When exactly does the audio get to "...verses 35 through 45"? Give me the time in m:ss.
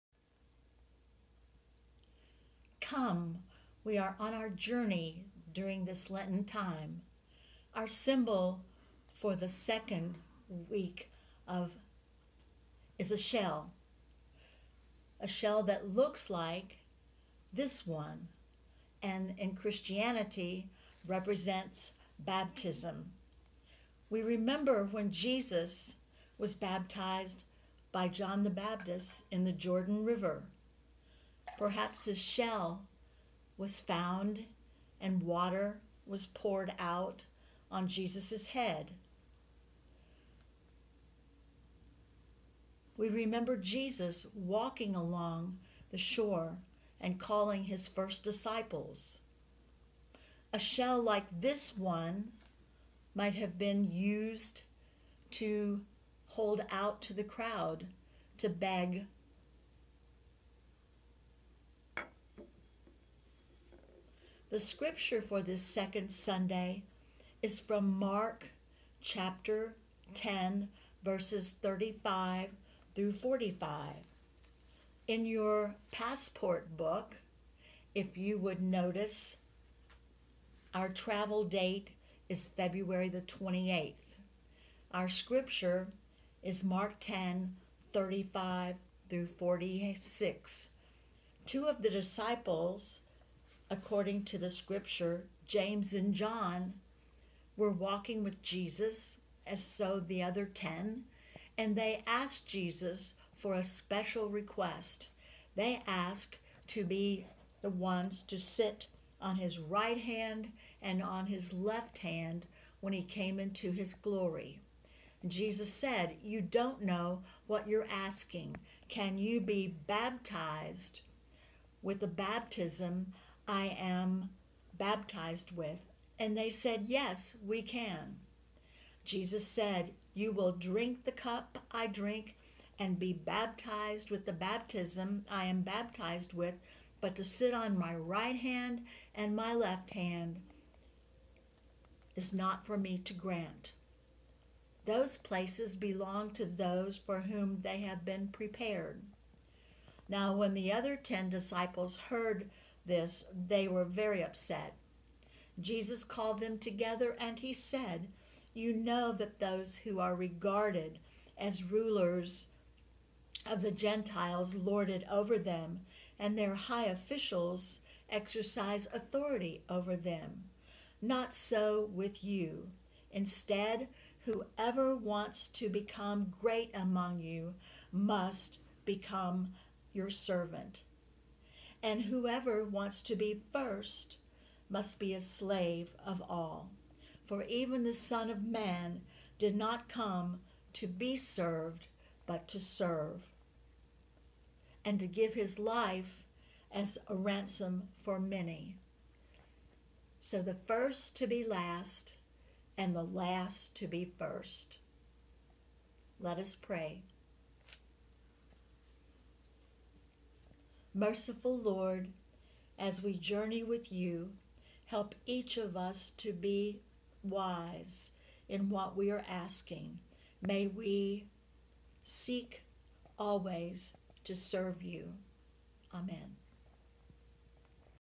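1:11.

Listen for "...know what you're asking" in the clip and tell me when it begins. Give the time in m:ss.
1:56.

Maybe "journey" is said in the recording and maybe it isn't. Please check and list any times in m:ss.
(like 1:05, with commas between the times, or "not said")
0:04, 3:33.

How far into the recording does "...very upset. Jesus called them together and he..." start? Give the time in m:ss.
2:33.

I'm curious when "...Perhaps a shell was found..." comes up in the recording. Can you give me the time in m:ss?
0:31.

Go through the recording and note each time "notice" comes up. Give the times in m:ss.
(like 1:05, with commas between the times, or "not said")
1:18.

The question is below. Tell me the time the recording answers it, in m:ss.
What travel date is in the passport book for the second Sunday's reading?
1:22.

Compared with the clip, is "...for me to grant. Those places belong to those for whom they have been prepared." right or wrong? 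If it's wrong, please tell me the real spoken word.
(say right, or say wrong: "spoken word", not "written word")
right.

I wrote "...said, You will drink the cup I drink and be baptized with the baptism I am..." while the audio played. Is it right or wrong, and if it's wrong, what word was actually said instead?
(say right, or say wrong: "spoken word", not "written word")
right.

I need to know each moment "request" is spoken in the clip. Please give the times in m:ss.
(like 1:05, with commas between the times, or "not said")
1:44.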